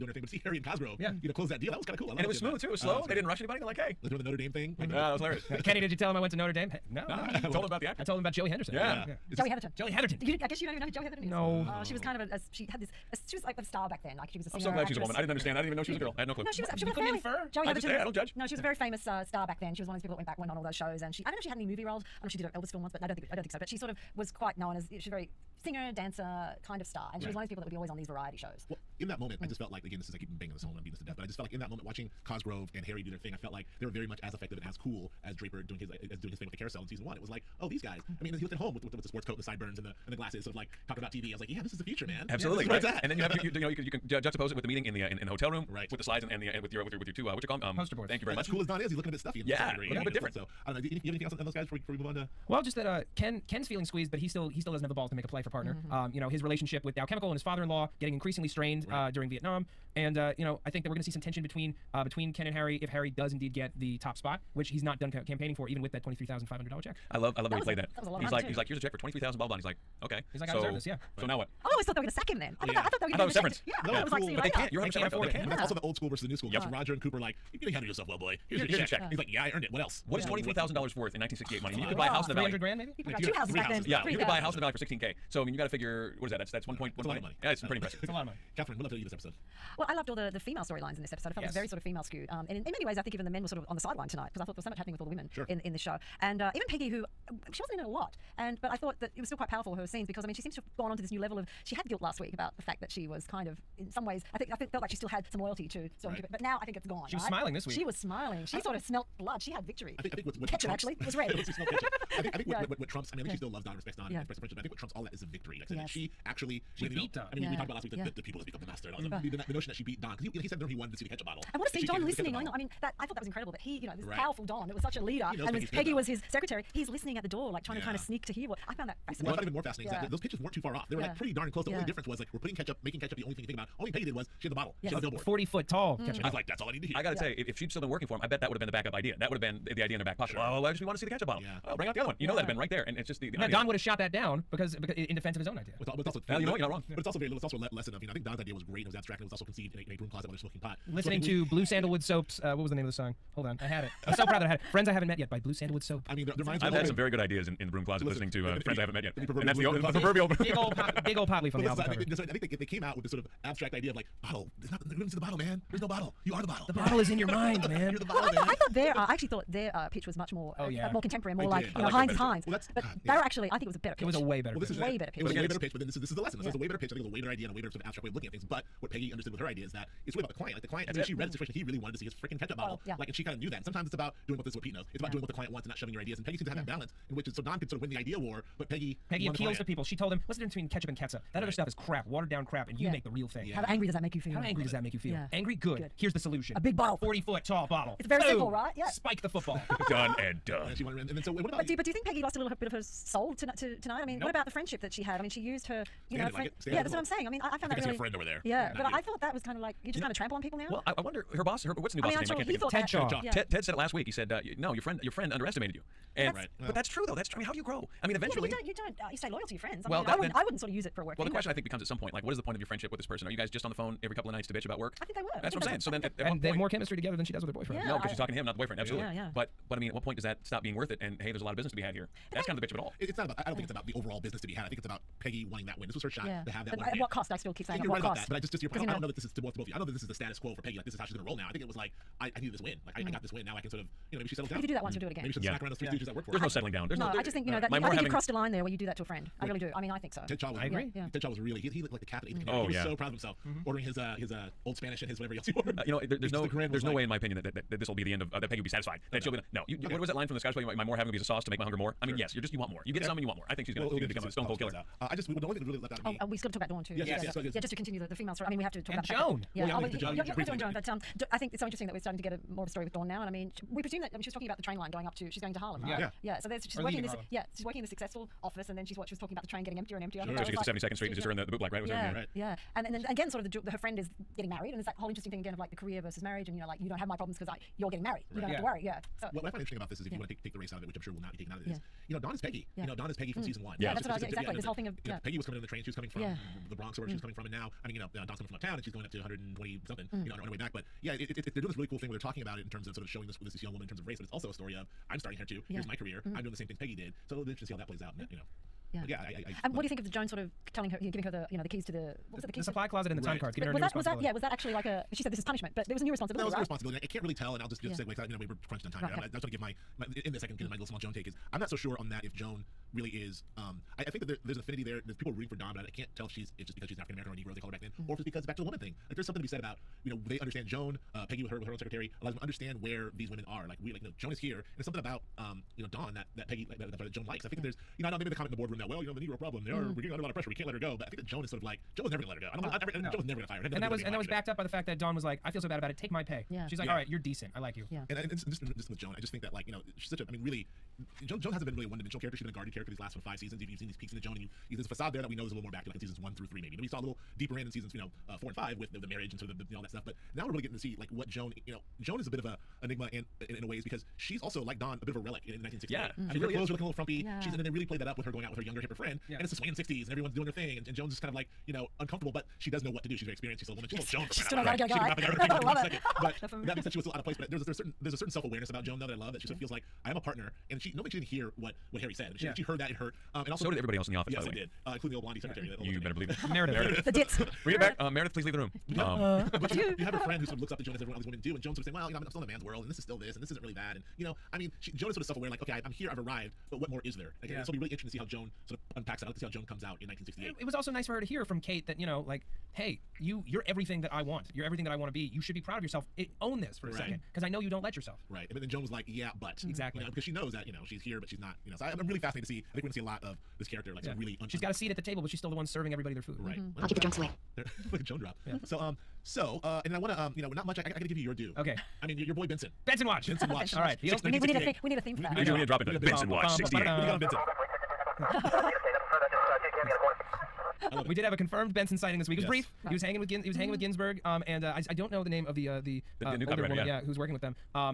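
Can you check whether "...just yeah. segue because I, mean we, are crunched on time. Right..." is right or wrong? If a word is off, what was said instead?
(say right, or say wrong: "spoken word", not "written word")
right.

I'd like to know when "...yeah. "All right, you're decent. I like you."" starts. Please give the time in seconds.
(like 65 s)
346 s.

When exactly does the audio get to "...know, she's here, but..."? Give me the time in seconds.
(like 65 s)
410 s.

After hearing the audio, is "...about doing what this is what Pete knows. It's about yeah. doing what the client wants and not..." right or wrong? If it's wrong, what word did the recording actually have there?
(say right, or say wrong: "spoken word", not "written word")
right.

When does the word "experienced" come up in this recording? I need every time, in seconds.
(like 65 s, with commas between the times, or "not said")
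373 s.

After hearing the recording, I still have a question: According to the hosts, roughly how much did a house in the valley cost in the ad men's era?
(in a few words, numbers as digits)
$16,000.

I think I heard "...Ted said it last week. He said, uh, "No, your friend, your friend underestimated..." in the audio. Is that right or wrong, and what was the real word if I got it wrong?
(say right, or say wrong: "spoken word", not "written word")
right.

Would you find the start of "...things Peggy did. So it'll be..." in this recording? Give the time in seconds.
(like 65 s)
306 s.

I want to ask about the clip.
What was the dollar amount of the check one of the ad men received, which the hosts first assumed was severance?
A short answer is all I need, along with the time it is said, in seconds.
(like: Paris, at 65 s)
$23,500, at 66 s.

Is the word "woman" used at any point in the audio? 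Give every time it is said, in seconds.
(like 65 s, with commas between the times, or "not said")
14 s, 303 s, 328 s, 373 s, 436 s.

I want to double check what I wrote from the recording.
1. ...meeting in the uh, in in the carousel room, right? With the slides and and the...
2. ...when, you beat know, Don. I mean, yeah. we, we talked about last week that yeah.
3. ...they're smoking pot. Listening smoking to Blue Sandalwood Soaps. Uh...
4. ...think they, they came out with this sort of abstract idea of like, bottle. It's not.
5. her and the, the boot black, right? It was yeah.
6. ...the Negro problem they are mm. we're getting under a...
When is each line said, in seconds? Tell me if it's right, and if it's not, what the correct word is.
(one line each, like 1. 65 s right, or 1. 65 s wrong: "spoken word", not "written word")
1. 44 s wrong: "hotel", not "carousel"
2. 116 s right
3. 150 s right
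4. 162 s right
5. 281 s right
6. 339 s right.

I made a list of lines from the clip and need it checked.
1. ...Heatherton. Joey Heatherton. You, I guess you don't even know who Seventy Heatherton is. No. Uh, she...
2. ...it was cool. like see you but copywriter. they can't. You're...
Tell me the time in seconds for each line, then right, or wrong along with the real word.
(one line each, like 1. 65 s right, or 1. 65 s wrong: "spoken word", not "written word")
1. 9 s wrong: "Joey", not "Seventy"
2. 74 s wrong: "later", not "copywriter".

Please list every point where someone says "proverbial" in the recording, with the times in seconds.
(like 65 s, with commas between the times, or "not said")
160 s.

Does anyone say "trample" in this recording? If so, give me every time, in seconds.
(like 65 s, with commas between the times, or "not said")
210 s.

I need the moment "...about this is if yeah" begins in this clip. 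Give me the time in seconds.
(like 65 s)
289 s.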